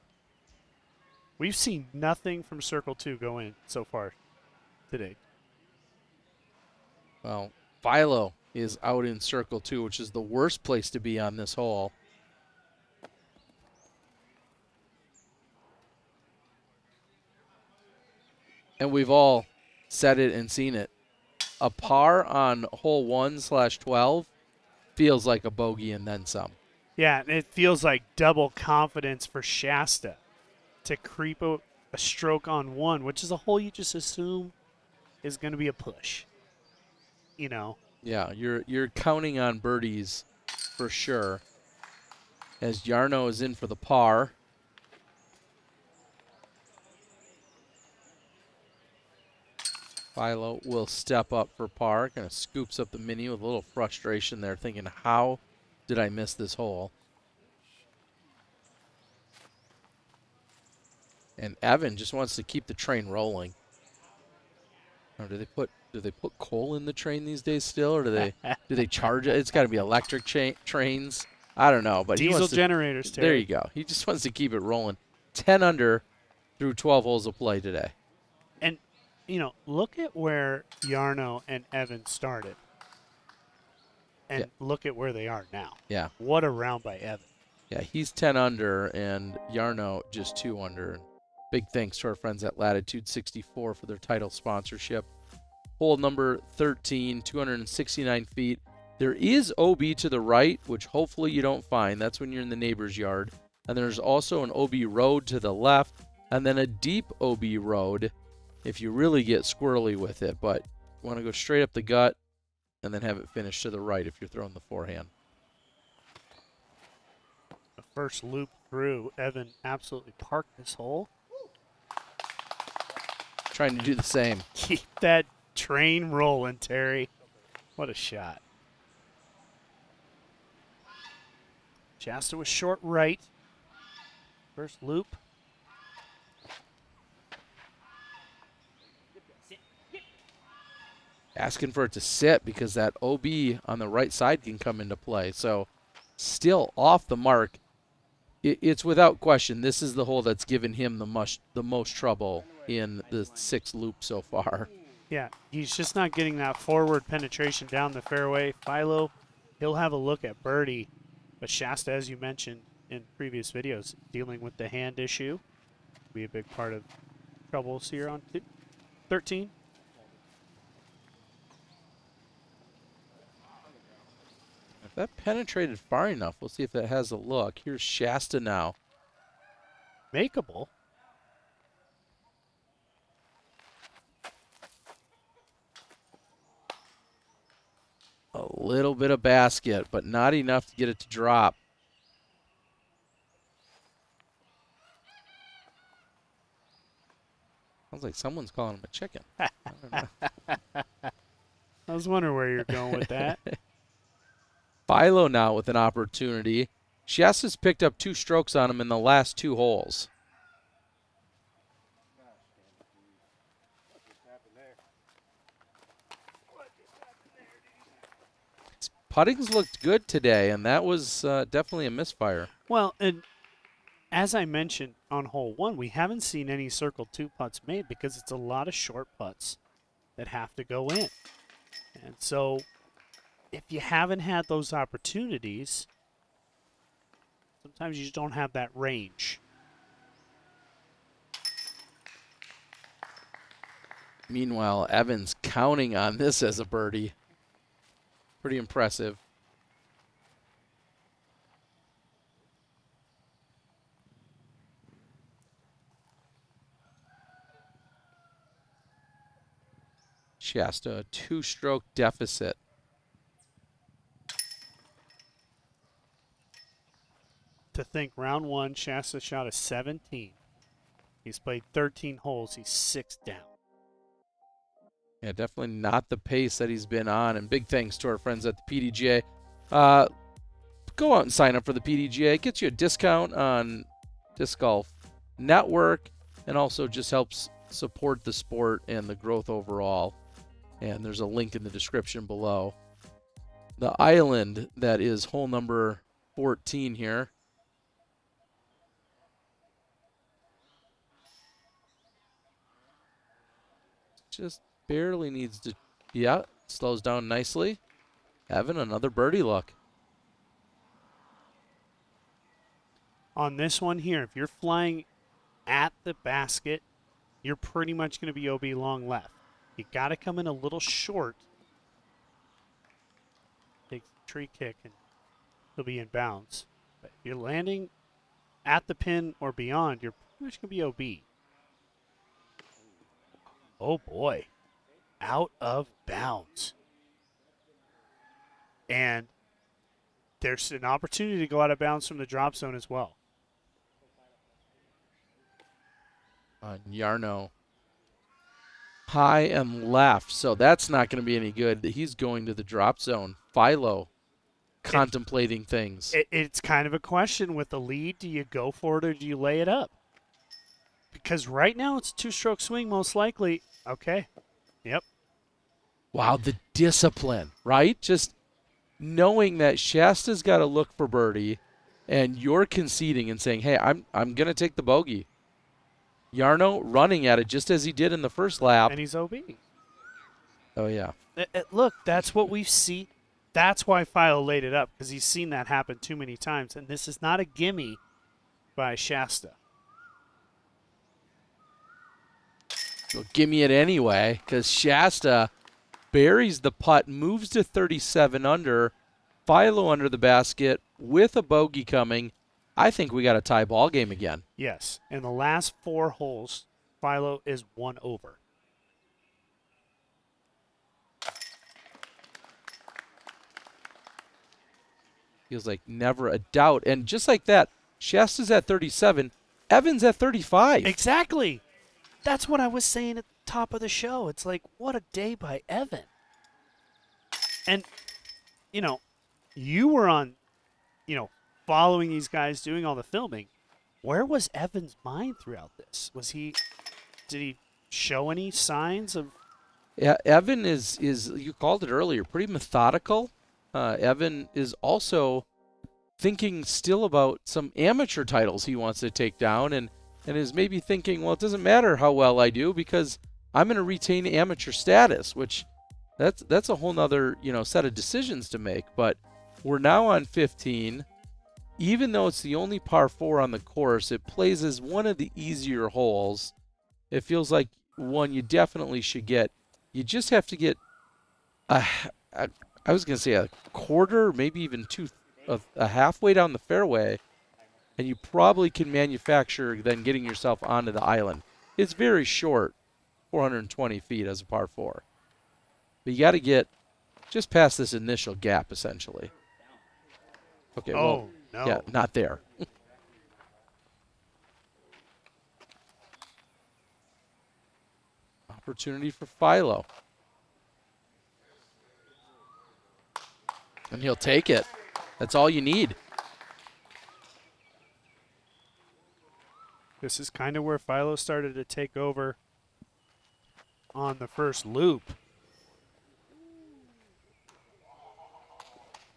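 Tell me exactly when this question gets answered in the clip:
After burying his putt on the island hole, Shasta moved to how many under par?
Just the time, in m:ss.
6:37.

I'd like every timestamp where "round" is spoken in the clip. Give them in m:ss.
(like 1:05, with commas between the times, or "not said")
1:26, 4:28.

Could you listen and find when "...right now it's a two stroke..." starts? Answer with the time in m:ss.
6:01.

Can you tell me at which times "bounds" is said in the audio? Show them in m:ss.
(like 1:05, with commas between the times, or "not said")
5:26, 5:36, 5:41.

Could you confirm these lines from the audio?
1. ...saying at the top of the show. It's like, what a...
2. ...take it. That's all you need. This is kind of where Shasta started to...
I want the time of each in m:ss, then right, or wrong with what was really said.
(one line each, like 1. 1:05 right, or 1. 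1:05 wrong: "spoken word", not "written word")
1. 7:02 right
2. 8:24 wrong: "Philo", not "Shasta".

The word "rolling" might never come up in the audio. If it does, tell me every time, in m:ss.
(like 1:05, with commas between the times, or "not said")
1:03, 1:14, 2:06.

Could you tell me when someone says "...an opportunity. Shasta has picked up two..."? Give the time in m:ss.
3:25.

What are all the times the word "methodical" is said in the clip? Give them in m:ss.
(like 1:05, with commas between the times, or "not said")
7:22.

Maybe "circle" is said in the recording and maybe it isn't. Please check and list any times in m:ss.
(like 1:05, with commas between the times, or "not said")
0:02, 0:09, 3:46.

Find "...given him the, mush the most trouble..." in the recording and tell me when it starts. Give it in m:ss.
2:30.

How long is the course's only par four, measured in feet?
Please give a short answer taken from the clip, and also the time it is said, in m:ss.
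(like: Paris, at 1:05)
420, at 8:03.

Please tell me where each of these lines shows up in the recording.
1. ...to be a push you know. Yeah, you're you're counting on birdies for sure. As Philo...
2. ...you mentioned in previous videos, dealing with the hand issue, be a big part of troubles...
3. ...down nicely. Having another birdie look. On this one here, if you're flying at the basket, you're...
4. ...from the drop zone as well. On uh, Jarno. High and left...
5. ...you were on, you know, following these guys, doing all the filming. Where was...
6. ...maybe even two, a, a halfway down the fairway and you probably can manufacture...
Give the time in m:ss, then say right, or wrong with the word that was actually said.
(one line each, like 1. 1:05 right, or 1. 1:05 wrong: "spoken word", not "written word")
1. 0:35 wrong: "Jarno", not "Philo"
2. 2:42 right
3. 5:07 right
4. 5:42 right
5. 7:09 right
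6. 7:54 right.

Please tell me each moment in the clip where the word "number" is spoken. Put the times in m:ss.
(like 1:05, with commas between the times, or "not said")
1:35, 4:55.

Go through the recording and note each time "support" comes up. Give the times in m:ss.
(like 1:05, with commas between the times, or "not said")
4:47.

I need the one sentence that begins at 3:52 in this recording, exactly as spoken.
And so if you haven't had those opportunities, sometimes you just don't have that range.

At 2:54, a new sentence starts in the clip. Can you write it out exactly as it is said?
If that penetrated far enough, we'll see if that has a look.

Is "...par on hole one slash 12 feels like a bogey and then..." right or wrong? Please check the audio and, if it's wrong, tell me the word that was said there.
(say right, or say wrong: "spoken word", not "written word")
right.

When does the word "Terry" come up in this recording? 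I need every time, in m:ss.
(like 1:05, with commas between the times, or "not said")
1:13, 2:06.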